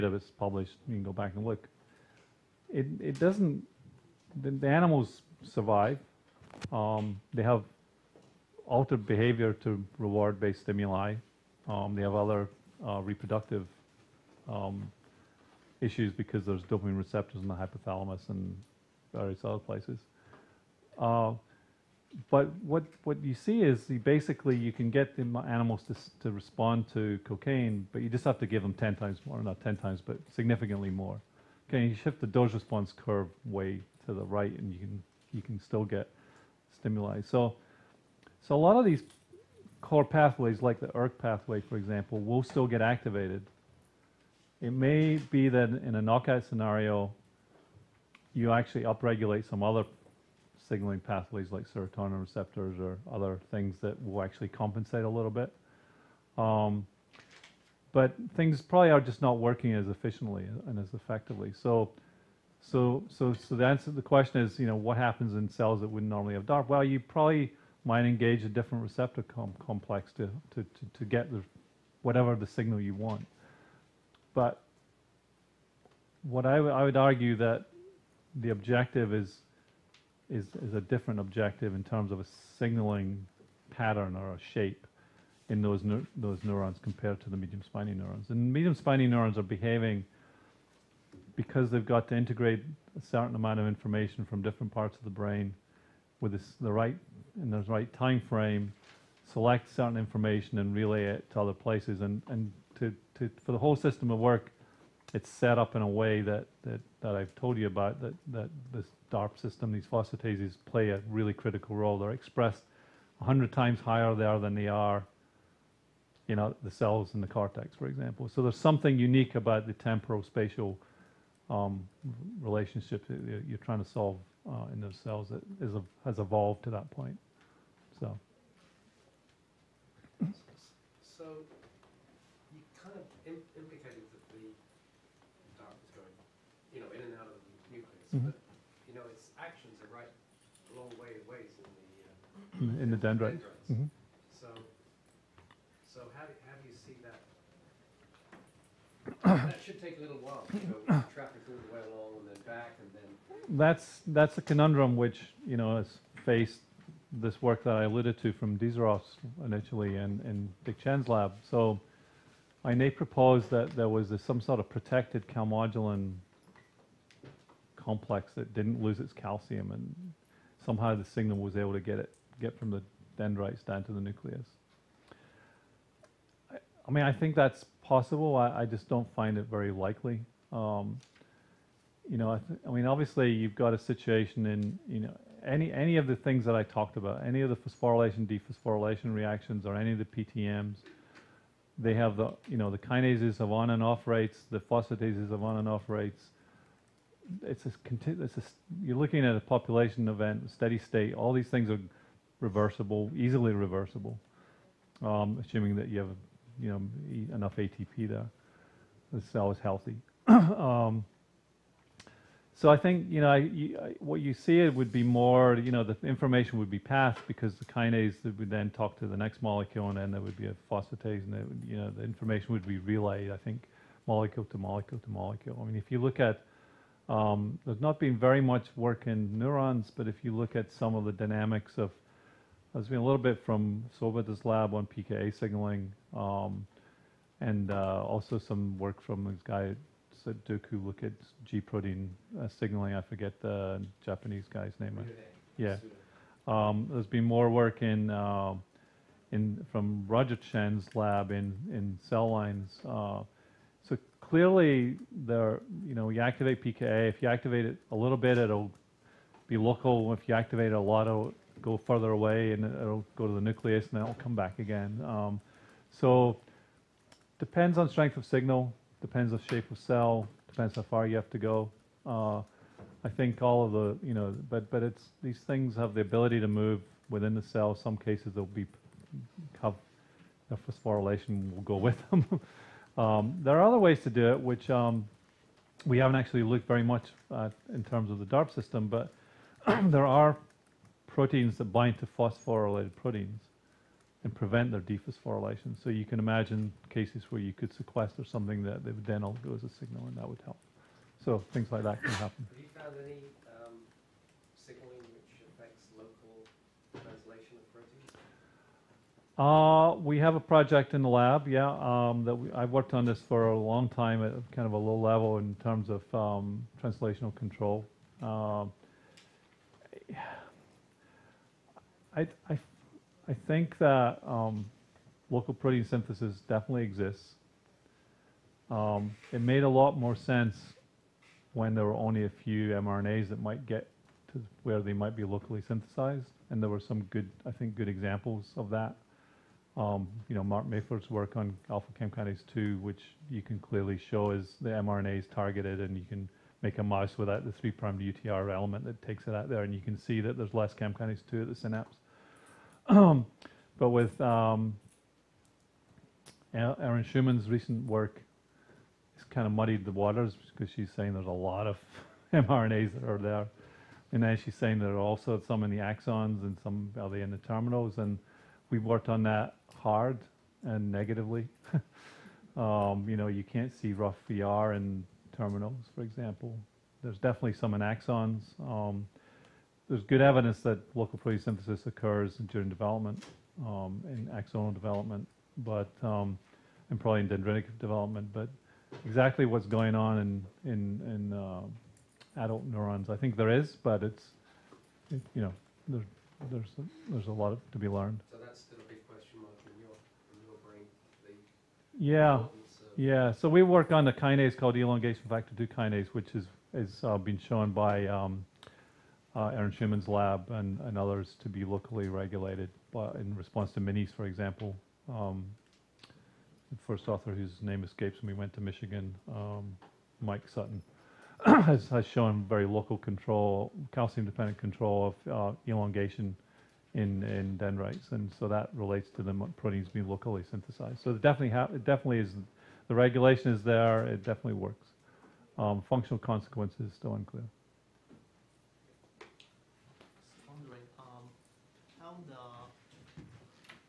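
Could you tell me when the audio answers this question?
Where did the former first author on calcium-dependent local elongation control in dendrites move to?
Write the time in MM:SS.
06:58.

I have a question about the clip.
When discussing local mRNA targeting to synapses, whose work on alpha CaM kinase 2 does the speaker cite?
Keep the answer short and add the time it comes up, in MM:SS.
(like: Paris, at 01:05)
Mark Mayford, at 05:40.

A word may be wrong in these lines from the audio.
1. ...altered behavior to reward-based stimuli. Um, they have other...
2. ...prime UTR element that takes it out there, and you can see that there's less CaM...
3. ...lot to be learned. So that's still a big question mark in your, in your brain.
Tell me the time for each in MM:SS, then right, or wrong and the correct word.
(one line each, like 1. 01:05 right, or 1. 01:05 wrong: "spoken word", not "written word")
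1. 00:08 right
2. 05:47 right
3. 06:37 right.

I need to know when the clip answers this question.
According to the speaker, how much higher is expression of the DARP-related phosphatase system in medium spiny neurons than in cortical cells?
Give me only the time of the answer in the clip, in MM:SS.
01:53.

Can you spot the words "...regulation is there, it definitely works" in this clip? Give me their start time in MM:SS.
07:12.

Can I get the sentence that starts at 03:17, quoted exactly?
It's a, it's a, you're looking at a population event, steady state.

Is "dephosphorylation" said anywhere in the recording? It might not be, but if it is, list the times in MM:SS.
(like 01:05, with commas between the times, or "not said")
03:08, 04:54.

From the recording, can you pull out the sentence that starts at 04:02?
I forget the Japanese guy's name.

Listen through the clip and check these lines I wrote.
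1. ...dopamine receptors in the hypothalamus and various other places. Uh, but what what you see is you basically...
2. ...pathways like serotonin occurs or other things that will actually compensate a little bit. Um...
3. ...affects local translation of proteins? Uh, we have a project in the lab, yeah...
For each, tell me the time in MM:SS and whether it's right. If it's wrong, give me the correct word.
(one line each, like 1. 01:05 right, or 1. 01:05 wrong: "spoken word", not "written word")
1. 00:16 right
2. 00:51 wrong: "receptors", not "occurs"
3. 05:05 right.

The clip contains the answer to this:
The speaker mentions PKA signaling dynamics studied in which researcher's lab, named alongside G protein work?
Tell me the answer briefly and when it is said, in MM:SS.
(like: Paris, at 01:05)
Sobeda, at 03:54.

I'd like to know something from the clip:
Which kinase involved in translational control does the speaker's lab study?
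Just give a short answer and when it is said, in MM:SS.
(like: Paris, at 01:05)
elongation factor 2 kinase, at 06:44.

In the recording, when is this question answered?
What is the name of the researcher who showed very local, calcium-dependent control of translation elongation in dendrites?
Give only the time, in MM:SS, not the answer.
07:00.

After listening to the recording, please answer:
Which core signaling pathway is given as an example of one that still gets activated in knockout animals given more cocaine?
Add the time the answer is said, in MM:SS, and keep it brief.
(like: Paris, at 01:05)
ERK pathway, at 00:40.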